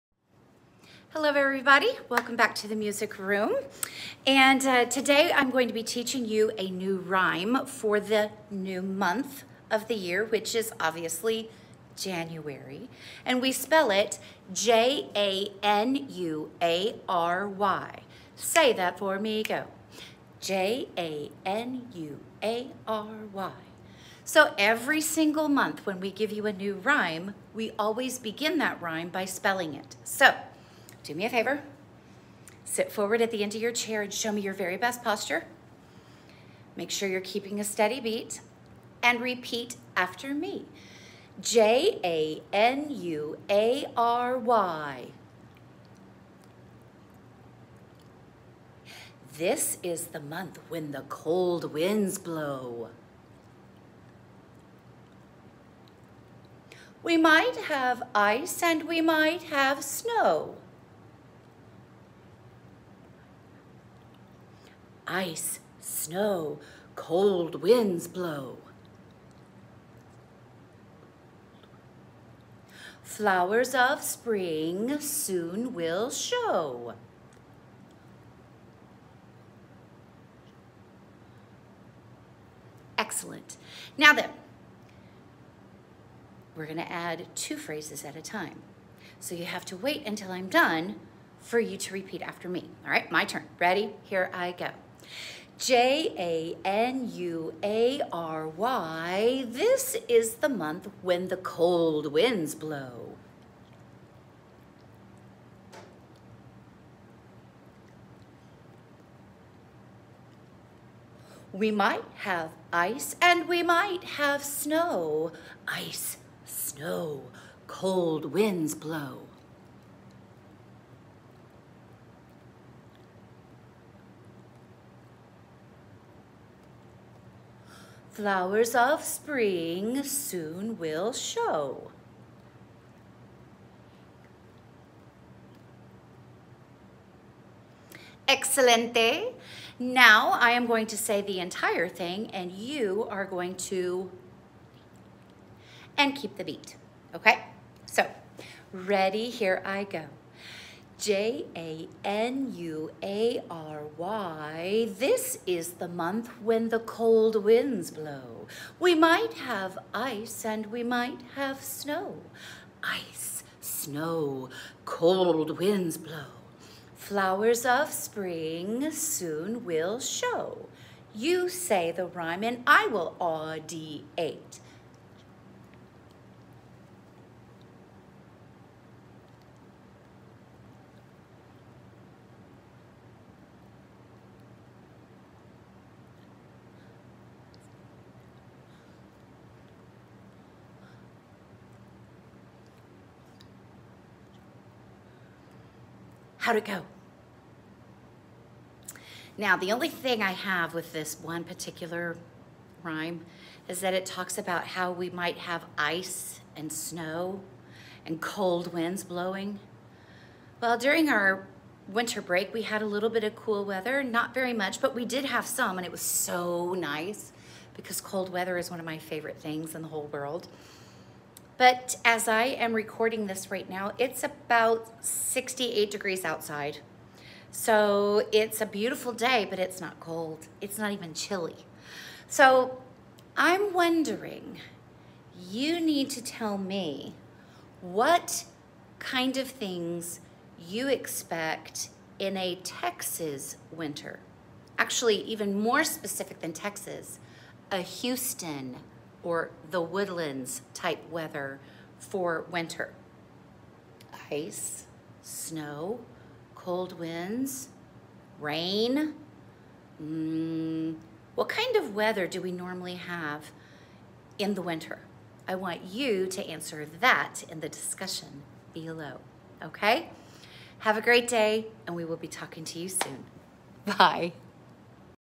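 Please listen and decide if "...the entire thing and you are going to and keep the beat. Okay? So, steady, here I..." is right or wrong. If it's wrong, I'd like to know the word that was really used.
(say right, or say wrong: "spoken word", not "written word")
wrong: "ready", not "steady".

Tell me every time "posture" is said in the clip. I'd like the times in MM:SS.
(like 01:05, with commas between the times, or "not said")
00:35.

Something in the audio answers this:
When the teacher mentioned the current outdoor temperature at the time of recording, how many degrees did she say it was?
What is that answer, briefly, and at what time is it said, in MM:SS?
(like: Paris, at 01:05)
68 degrees, at 03:45.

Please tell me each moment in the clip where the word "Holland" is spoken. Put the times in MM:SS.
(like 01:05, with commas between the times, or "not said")
not said.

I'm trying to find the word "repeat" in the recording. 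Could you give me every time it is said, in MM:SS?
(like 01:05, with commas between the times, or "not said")
00:39, 01:31.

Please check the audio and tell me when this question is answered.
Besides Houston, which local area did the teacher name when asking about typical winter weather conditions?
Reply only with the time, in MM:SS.
04:09.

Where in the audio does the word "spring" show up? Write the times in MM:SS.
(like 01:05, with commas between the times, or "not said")
01:14, 02:09, 02:47.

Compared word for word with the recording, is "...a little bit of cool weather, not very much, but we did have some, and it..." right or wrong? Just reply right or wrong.
right.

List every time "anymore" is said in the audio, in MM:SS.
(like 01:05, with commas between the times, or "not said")
not said.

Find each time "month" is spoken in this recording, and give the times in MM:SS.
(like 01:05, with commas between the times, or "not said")
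00:08, 00:25, 00:50, 01:40, 02:35.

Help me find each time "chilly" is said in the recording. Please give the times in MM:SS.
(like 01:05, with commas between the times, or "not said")
03:51.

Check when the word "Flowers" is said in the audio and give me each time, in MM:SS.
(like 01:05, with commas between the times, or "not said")
01:13, 02:08, 02:46.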